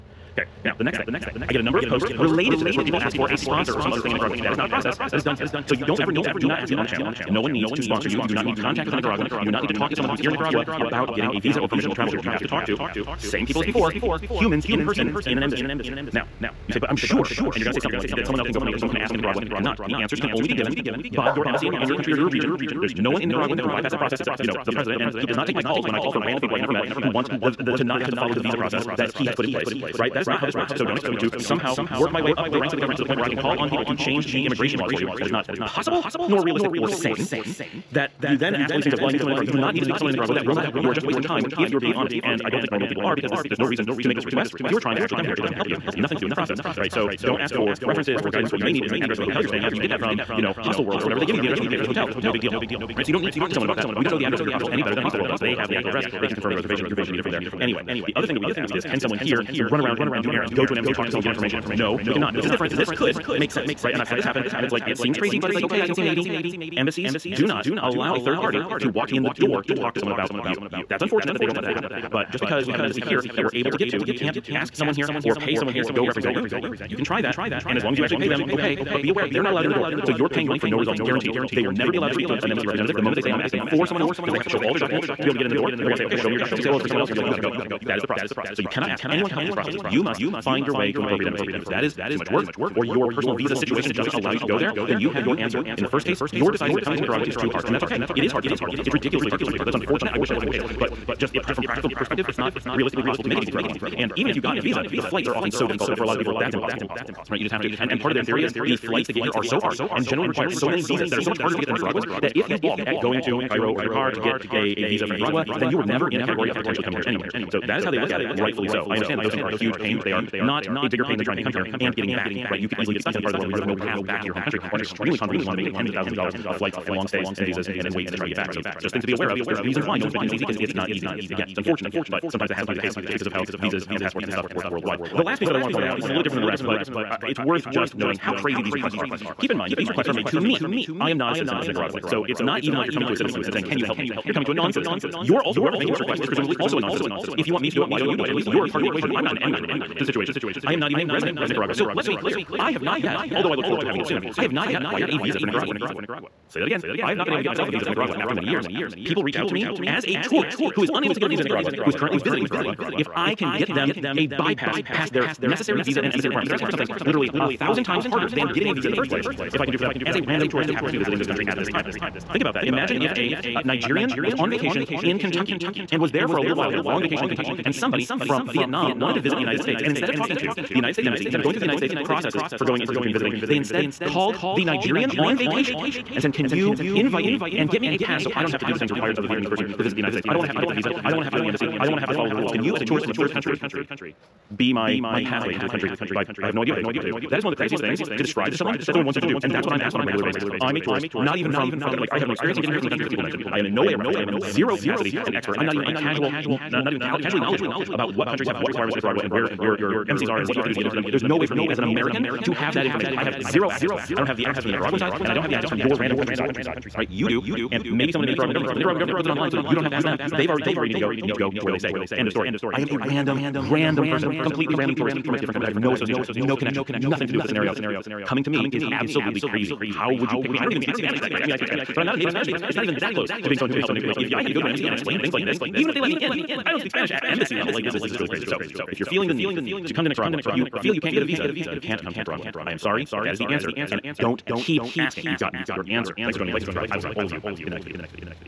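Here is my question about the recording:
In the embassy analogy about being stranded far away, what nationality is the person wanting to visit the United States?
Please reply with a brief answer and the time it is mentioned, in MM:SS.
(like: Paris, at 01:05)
Vietnamese, at 02:58.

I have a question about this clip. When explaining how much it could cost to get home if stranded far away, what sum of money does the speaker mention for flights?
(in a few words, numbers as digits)
tens of thousands of dollars.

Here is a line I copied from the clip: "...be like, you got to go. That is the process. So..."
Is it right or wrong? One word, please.
right.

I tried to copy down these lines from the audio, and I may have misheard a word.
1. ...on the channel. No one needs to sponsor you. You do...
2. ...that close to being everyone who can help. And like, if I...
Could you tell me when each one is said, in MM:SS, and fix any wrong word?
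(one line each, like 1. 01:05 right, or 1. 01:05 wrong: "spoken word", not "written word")
1. 00:06 right
2. 03:52 wrong: "someone", not "everyone".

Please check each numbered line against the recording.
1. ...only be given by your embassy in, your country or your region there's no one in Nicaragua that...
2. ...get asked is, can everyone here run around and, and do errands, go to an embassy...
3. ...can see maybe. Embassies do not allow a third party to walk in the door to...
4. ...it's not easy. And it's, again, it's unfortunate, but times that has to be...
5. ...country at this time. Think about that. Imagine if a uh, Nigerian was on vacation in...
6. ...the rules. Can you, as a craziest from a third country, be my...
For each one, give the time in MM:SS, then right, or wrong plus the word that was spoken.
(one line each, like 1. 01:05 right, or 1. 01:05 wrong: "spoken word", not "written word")
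1. 00:20 right
2. 00:58 wrong: "someone", not "everyone"
3. 01:05 right
4. 02:10 wrong: "sometimes", not "times"
5. 02:51 right
6. 03:12 wrong: "tourist", not "craziest".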